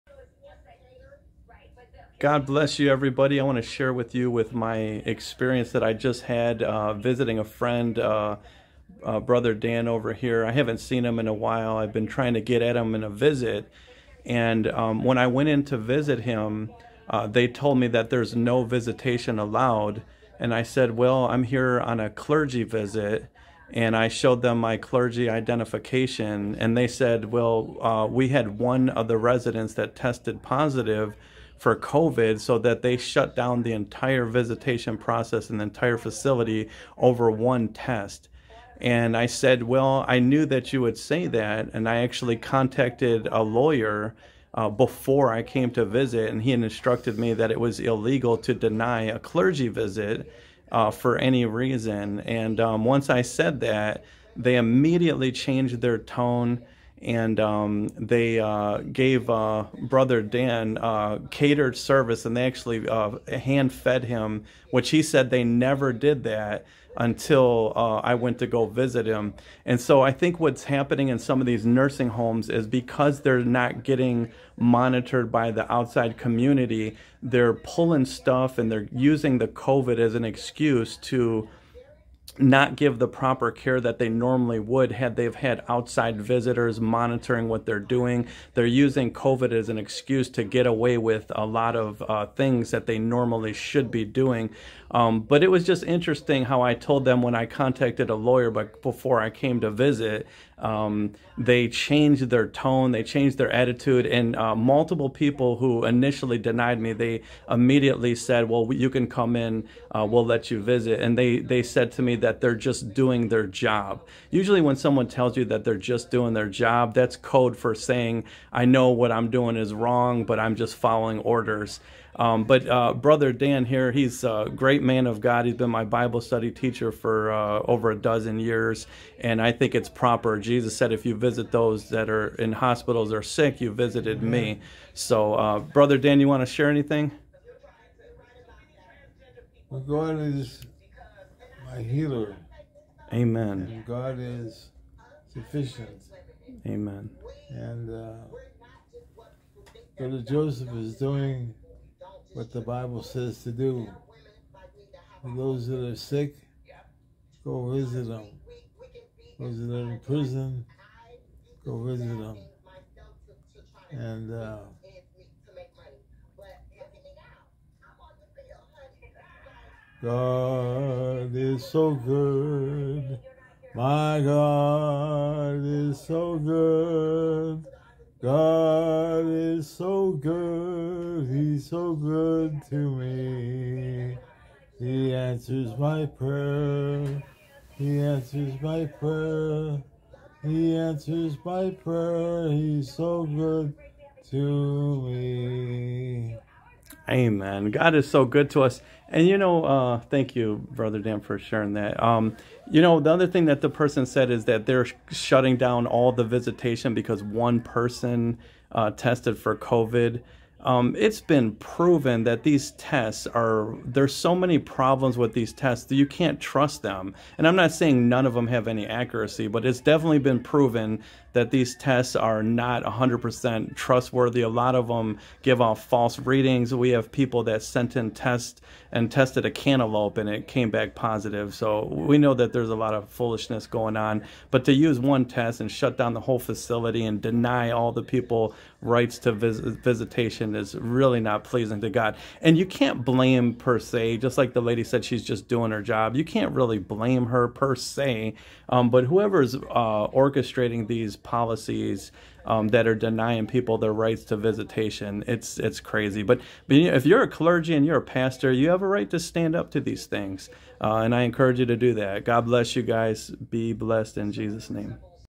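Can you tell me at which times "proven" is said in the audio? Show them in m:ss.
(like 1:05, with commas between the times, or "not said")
3:31, 3:40.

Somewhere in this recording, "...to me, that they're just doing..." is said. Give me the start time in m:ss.
1:51.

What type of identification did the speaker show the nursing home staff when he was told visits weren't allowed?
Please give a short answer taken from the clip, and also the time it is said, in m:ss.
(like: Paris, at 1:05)
Clergy identification, at 0:24.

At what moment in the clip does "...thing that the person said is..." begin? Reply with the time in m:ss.
3:23.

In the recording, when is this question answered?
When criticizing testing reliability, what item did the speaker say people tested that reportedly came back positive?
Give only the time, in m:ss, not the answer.
3:49.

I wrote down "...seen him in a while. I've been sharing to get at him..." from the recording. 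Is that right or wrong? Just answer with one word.
wrong.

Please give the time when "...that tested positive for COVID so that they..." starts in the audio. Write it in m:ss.
0:29.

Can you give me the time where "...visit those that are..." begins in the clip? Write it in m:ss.
2:11.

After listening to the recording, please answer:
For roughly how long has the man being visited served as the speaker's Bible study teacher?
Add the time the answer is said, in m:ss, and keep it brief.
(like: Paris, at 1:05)
Over a dozen years, at 2:07.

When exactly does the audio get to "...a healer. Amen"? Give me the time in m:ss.
2:21.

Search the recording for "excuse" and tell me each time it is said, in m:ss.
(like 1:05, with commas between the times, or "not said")
1:20, 1:29.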